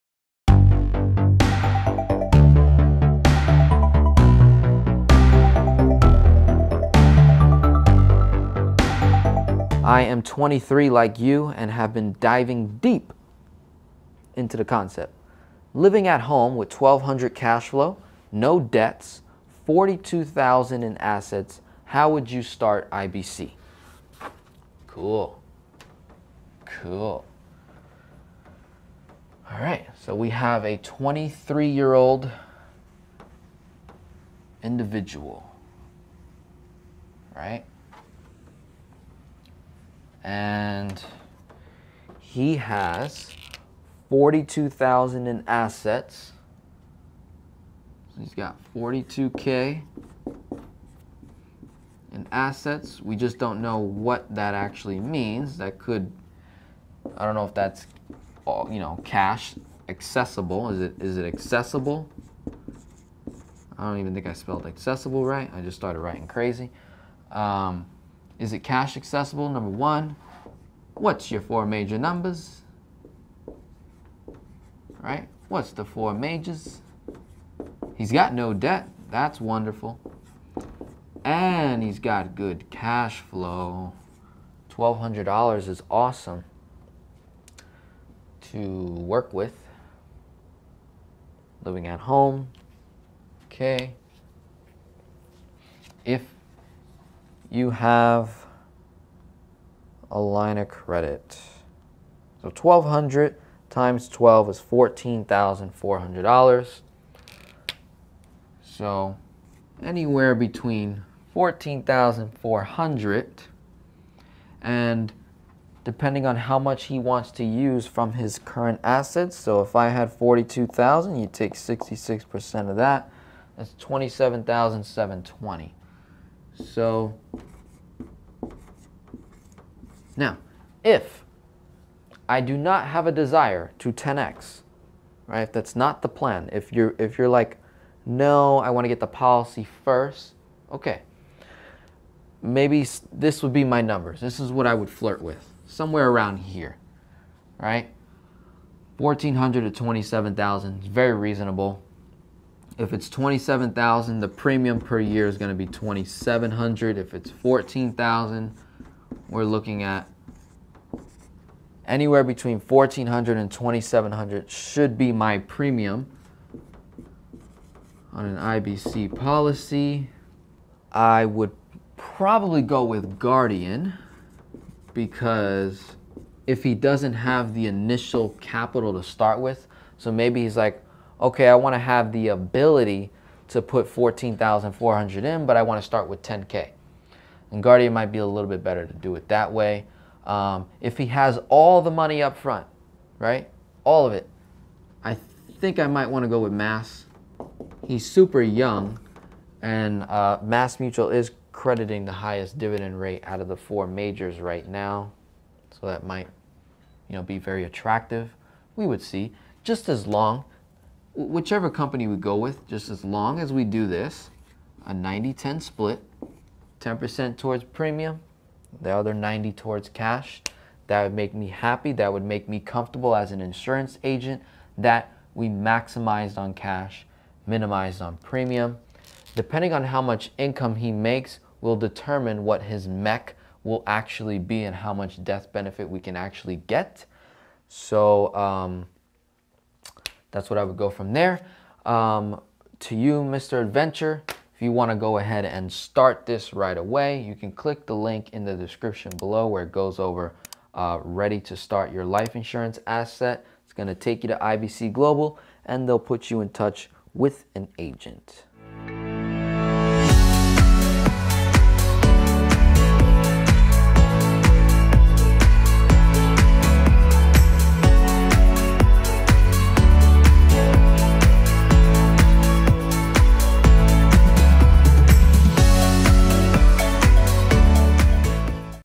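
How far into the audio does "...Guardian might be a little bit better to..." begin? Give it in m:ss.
3:07.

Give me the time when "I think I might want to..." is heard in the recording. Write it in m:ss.
3:15.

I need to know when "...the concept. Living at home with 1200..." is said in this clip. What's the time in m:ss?
0:14.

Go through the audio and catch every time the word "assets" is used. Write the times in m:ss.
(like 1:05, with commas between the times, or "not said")
0:20, 0:45, 0:52, 4:12.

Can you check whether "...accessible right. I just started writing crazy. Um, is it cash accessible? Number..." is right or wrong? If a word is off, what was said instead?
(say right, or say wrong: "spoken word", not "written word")
right.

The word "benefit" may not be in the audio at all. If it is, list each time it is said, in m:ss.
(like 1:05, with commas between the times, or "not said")
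3:55.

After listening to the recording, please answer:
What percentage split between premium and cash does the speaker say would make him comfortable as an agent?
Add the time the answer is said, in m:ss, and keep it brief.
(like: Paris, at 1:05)
90-10, at 3:34.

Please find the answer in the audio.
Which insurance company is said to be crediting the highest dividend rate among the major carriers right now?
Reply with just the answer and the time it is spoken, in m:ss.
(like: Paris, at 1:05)
Mass Mutual, at 3:20.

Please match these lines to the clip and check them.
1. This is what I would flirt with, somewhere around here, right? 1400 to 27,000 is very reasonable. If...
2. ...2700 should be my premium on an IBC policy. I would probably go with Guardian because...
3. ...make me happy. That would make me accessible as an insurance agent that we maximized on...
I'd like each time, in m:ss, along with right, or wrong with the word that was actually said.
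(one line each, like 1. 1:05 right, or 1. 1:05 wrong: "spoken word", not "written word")
1. 2:24 right
2. 2:43 right
3. 3:41 wrong: "comfortable", not "accessible".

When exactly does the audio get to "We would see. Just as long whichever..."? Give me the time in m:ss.
3:28.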